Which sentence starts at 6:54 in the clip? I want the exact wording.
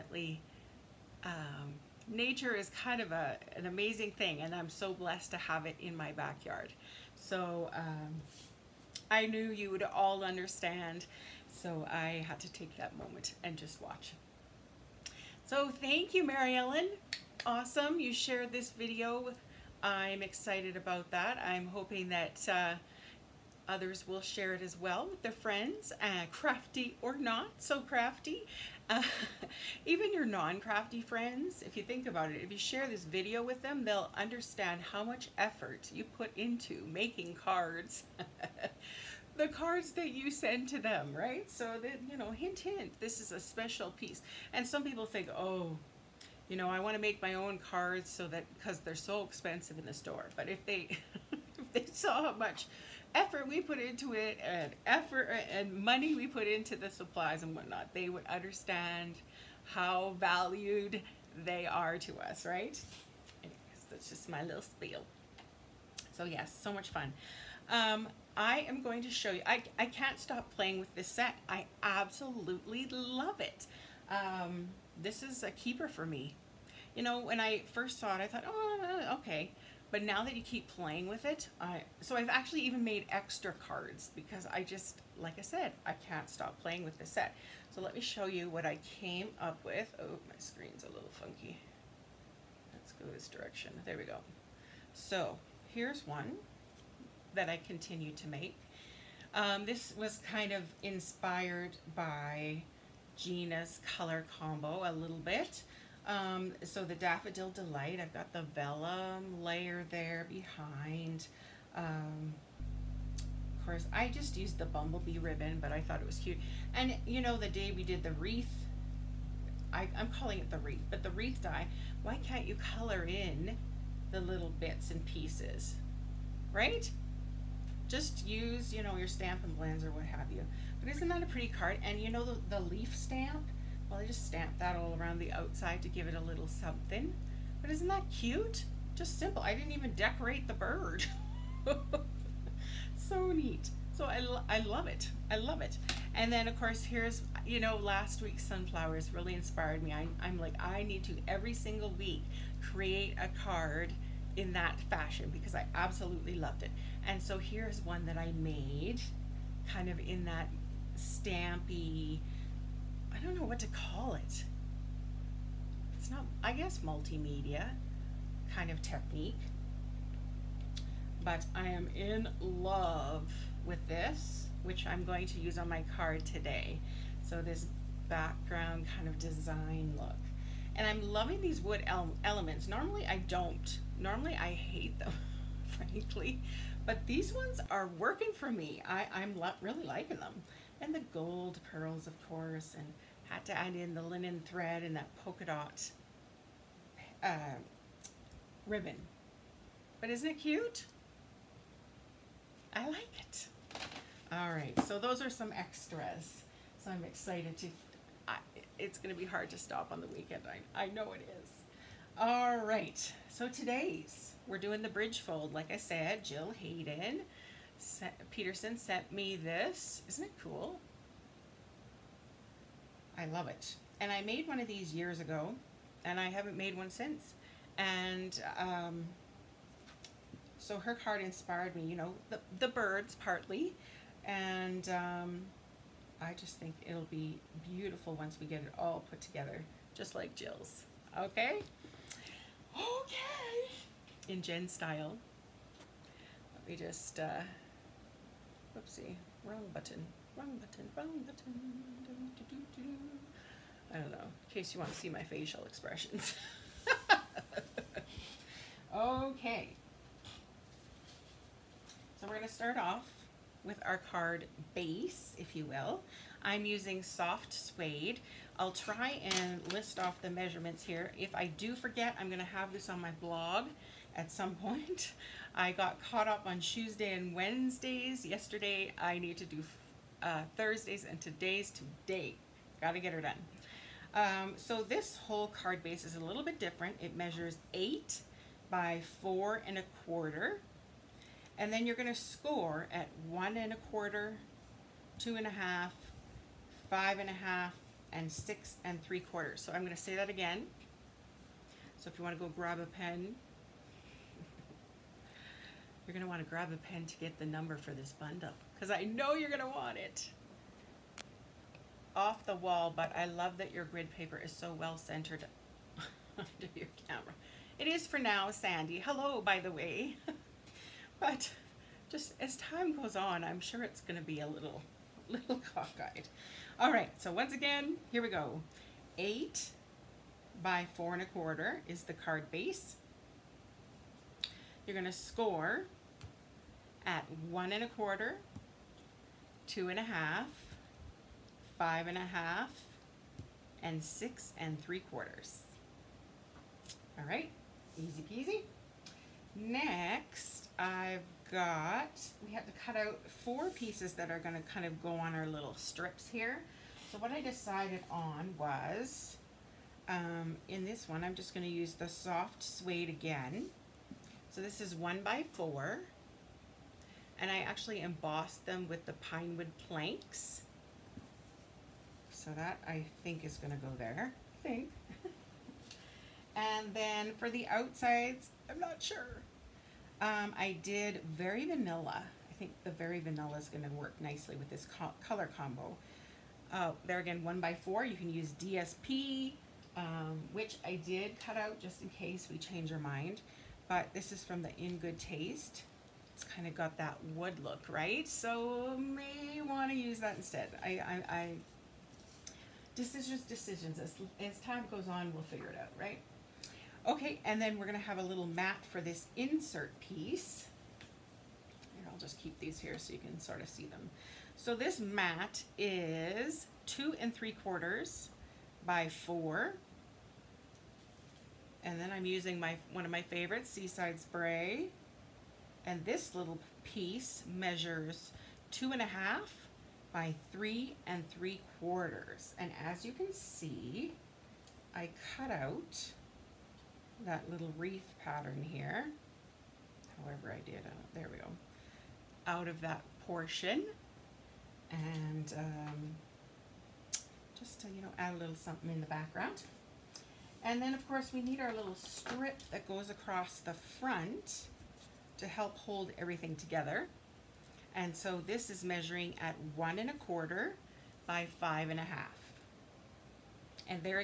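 So this mat is two and three quarters by four.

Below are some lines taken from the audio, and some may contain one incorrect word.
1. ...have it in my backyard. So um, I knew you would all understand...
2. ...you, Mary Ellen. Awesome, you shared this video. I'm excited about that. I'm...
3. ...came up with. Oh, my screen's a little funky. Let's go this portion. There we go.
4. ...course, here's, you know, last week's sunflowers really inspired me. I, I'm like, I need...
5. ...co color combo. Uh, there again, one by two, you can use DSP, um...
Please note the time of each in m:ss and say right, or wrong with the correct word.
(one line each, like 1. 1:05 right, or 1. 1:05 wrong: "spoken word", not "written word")
1. 0:05 right
2. 0:16 right
3. 1:28 wrong: "direction", not "portion"
4. 2:26 right
5. 6:24 wrong: "four", not "two".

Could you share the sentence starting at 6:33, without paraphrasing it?
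But this is from the In Good Taste it's kind of got that wood look, right?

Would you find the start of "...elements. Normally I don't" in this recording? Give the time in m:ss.
3:02.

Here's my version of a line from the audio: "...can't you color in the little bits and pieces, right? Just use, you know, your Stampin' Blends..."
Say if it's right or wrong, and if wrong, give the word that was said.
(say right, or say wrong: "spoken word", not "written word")
right.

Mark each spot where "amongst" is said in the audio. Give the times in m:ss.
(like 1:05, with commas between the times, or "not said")
not said.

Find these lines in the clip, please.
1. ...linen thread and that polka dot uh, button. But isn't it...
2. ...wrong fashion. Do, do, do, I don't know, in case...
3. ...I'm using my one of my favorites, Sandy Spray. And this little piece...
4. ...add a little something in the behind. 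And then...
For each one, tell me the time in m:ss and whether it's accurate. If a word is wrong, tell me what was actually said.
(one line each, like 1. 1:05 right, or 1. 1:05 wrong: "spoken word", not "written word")
1. 3:14 wrong: "ribbon", not "button"
2. 4:10 wrong: "button", not "fashion"
3. 7:02 wrong: "Seaside", not "Sandy"
4. 7:28 wrong: "background", not "behind".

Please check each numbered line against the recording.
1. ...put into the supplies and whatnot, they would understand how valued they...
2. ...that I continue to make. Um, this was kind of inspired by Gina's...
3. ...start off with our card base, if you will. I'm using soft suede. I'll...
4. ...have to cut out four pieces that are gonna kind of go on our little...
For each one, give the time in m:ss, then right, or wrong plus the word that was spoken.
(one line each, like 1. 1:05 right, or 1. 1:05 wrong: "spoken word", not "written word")
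1. 0:56 right
2. 1:37 right
3. 4:22 right
4. 5:52 right.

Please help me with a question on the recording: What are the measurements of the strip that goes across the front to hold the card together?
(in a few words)
1 1/4 by 5 1/2.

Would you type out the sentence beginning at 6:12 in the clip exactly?
So that I think is gonna go there, I think.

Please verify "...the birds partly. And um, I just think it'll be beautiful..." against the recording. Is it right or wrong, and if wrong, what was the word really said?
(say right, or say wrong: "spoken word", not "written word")
right.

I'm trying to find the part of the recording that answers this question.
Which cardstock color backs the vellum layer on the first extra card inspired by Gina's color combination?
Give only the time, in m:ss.
1:46.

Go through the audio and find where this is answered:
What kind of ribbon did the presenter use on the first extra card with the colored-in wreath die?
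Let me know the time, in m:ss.
1:54.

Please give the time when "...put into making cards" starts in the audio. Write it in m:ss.
0:36.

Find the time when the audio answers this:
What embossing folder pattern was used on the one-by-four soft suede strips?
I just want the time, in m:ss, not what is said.
6:09.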